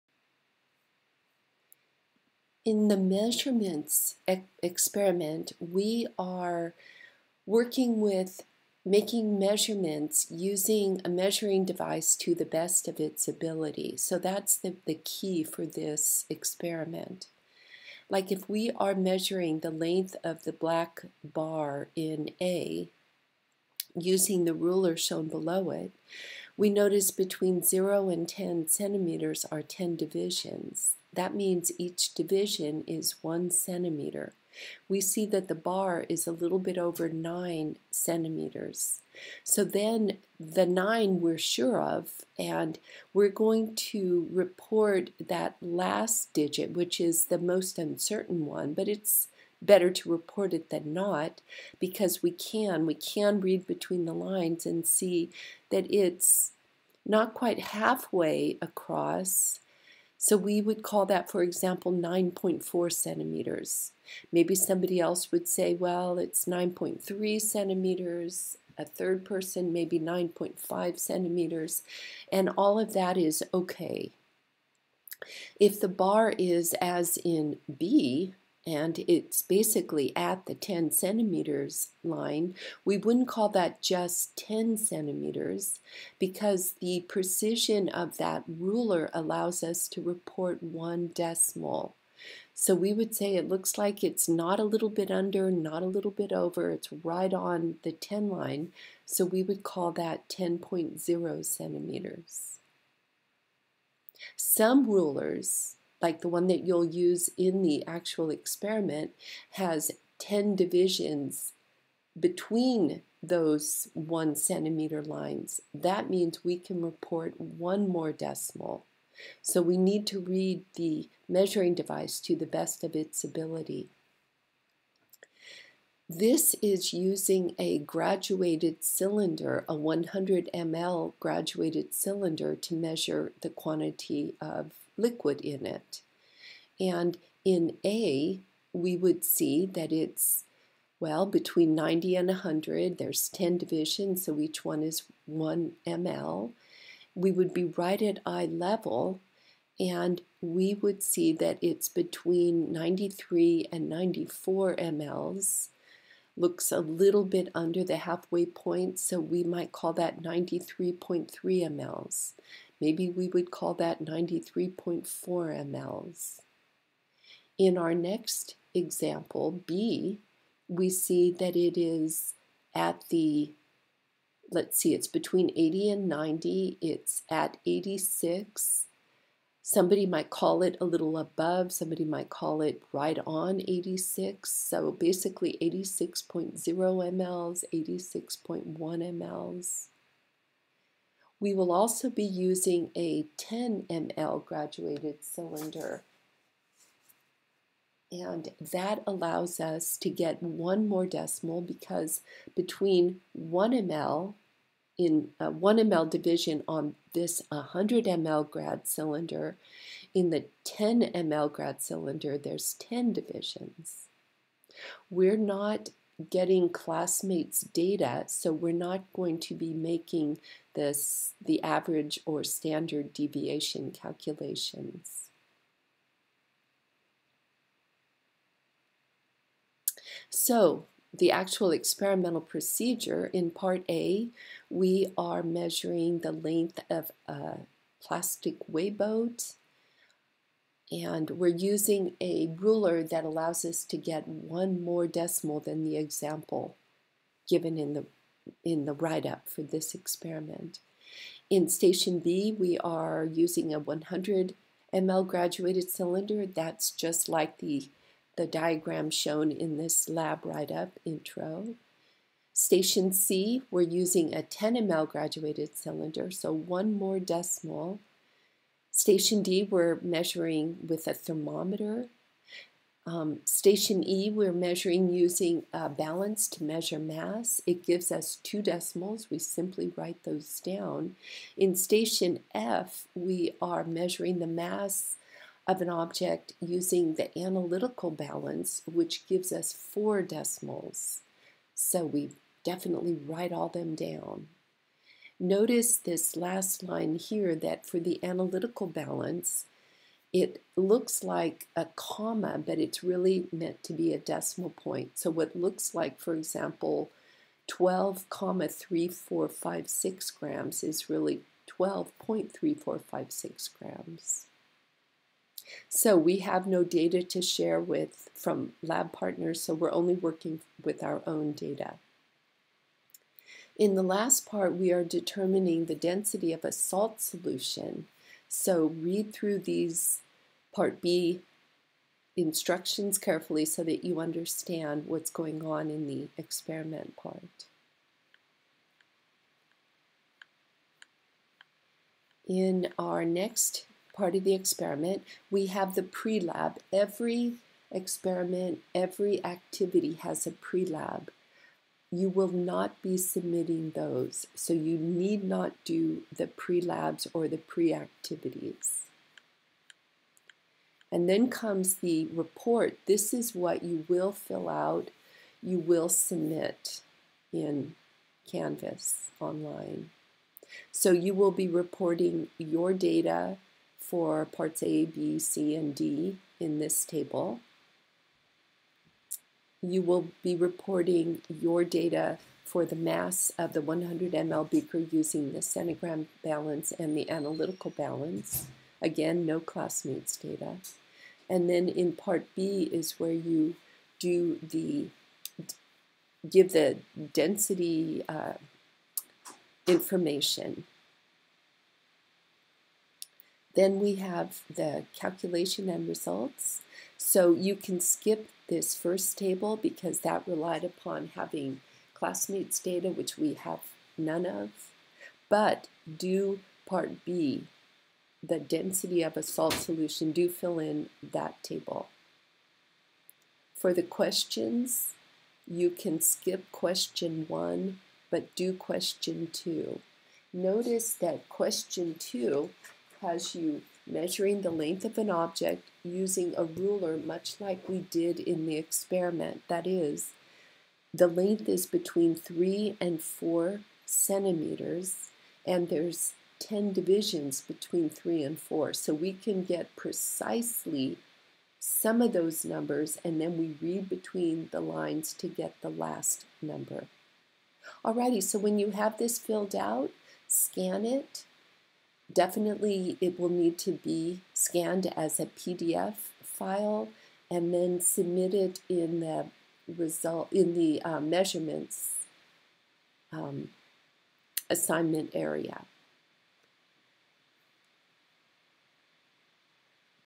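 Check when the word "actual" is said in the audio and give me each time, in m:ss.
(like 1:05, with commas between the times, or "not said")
1:47, 3:51.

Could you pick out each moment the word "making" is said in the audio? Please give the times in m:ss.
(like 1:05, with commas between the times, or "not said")
0:08, 3:39.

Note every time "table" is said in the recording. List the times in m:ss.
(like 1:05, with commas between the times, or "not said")
6:17, 6:49, 7:01.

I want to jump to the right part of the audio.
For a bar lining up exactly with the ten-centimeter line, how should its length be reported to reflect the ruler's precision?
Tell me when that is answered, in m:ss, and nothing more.
1:40.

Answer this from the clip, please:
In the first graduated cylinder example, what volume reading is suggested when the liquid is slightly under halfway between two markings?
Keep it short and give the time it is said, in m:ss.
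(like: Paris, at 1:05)
93.3 mL, at 2:40.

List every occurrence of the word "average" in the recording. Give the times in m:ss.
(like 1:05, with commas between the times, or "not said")
3:41.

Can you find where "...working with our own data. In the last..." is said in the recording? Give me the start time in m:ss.
5:20.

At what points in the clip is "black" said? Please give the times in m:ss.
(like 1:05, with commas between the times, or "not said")
0:20.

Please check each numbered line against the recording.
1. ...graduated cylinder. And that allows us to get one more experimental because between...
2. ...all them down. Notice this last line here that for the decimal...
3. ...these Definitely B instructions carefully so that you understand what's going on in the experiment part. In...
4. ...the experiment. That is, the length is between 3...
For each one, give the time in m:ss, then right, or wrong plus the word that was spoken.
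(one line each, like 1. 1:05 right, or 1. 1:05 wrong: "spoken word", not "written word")
1. 3:14 wrong: "decimal", not "experimental"
2. 4:53 wrong: "analytical", not "decimal"
3. 5:29 wrong: "Part", not "Definitely"
4. 7:18 right.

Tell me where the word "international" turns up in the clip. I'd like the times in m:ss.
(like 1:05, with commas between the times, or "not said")
not said.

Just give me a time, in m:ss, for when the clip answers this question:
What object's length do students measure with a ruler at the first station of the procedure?
3:58.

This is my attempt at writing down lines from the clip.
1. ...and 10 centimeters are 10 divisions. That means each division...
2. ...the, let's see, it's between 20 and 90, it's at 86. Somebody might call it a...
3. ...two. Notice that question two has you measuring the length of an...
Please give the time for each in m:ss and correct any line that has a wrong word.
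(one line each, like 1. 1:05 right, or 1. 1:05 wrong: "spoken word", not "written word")
1. 0:28 right
2. 2:53 wrong: "80", not "20"
3. 7:09 right.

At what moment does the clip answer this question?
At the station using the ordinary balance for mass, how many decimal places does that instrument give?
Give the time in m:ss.
4:38.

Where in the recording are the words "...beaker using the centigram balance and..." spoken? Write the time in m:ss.
6:24.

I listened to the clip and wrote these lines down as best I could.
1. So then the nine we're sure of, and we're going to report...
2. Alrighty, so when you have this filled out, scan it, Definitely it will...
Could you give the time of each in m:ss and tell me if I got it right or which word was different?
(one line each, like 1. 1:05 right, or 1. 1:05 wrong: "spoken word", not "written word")
1. 0:39 right
2. 7:38 right.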